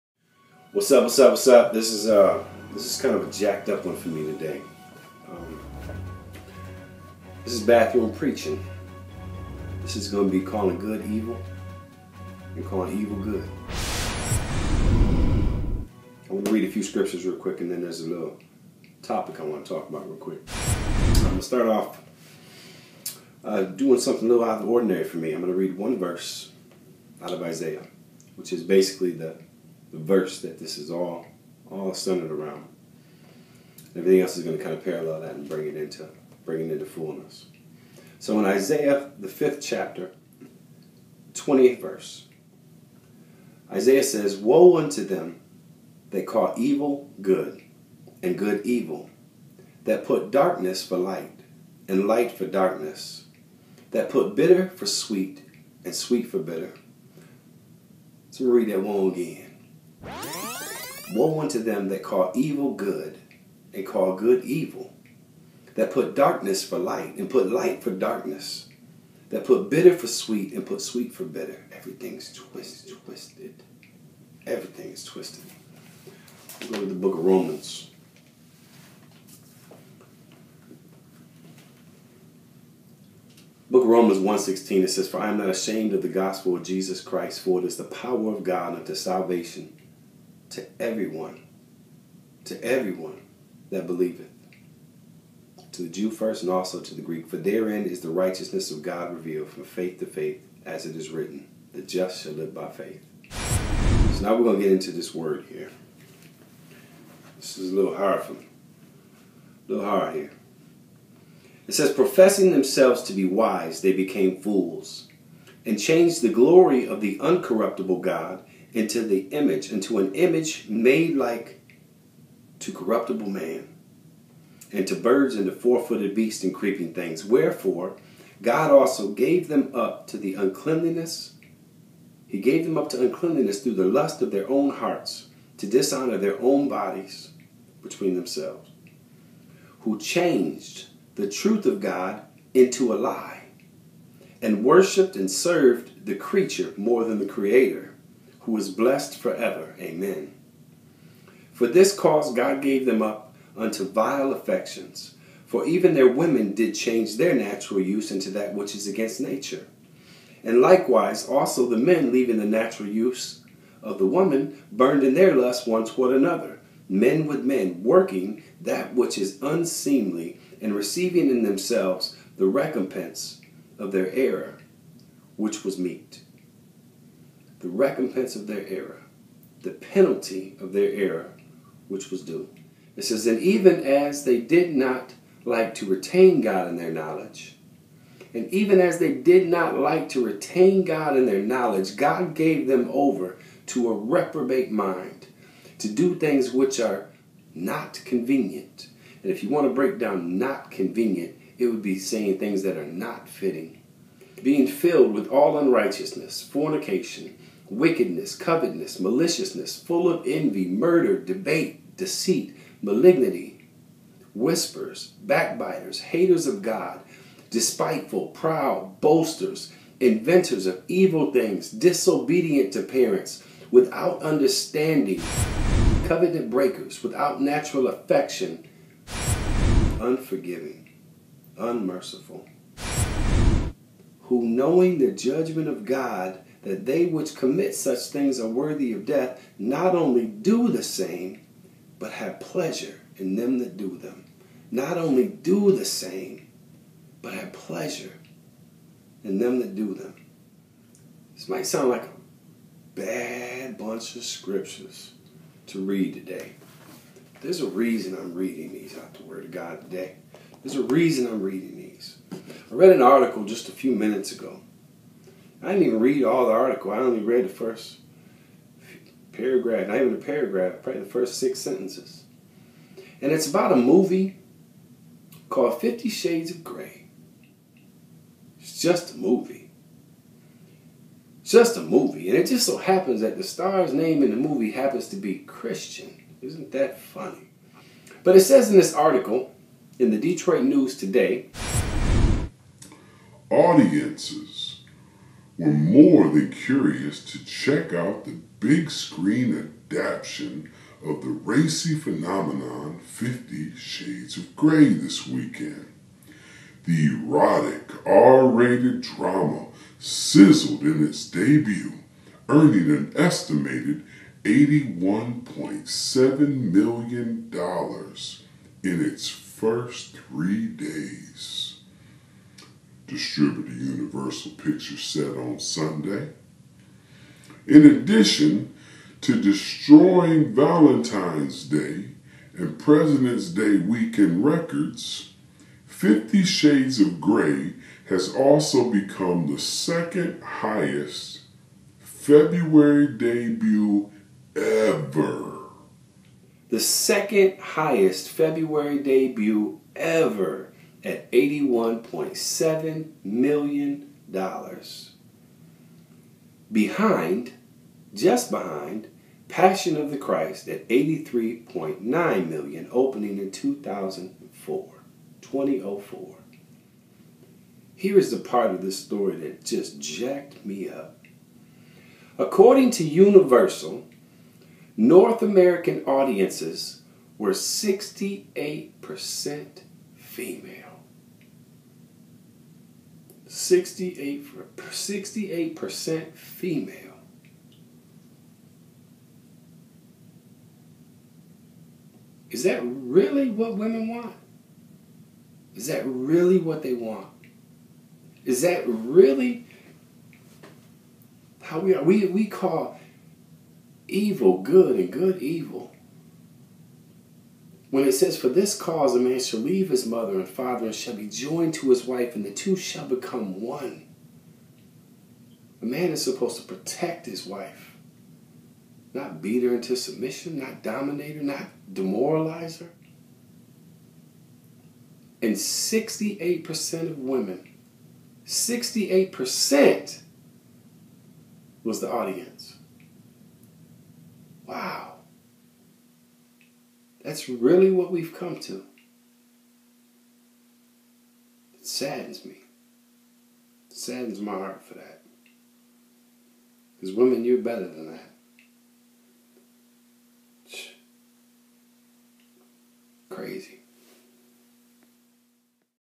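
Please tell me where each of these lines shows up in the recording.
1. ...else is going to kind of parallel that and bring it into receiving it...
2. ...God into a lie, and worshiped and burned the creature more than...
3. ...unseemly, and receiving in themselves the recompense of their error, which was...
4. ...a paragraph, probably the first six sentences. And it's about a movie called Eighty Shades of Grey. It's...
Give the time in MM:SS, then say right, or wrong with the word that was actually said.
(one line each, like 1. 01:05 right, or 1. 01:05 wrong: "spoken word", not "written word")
1. 00:34 wrong: "bring", not "receiving"
2. 02:21 wrong: "served", not "burned"
3. 02:49 right
4. 04:30 wrong: "Fifty", not "Eighty".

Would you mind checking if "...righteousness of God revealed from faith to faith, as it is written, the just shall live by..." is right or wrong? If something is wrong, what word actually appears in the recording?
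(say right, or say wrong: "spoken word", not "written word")
right.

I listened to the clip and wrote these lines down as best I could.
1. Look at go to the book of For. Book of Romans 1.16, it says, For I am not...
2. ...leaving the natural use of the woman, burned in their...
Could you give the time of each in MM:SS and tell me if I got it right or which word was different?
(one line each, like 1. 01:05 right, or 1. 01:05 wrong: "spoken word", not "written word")
1. 01:16 wrong: "Romans", not "For"
2. 02:42 right.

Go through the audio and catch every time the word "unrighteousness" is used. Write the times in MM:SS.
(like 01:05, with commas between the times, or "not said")
03:25.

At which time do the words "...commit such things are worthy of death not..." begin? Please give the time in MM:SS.
03:57.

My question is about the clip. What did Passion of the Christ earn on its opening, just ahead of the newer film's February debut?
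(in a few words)
$83.9 million.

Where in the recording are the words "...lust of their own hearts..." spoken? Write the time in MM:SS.
02:13.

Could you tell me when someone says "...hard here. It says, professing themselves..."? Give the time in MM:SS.
01:49.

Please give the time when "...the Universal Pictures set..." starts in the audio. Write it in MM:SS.
05:23.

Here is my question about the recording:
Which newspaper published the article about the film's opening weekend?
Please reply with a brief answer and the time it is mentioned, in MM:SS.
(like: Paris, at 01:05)
The Detroit News, at 04:50.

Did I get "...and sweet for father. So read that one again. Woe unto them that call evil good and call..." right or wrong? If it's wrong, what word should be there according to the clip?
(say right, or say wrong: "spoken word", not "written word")
wrong: "bitter", not "father".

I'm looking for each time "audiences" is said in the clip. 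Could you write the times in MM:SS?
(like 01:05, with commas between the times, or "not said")
04:53, 06:16, 07:12.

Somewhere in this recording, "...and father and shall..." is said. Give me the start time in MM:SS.
06:50.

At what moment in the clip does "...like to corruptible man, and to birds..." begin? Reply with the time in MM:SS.
02:01.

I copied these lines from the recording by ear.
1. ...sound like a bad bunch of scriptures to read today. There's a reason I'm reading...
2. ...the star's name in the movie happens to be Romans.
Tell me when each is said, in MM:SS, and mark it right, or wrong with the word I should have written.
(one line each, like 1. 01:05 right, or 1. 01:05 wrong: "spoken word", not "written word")
1. 04:11 right
2. 04:43 wrong: "Christian", not "Romans".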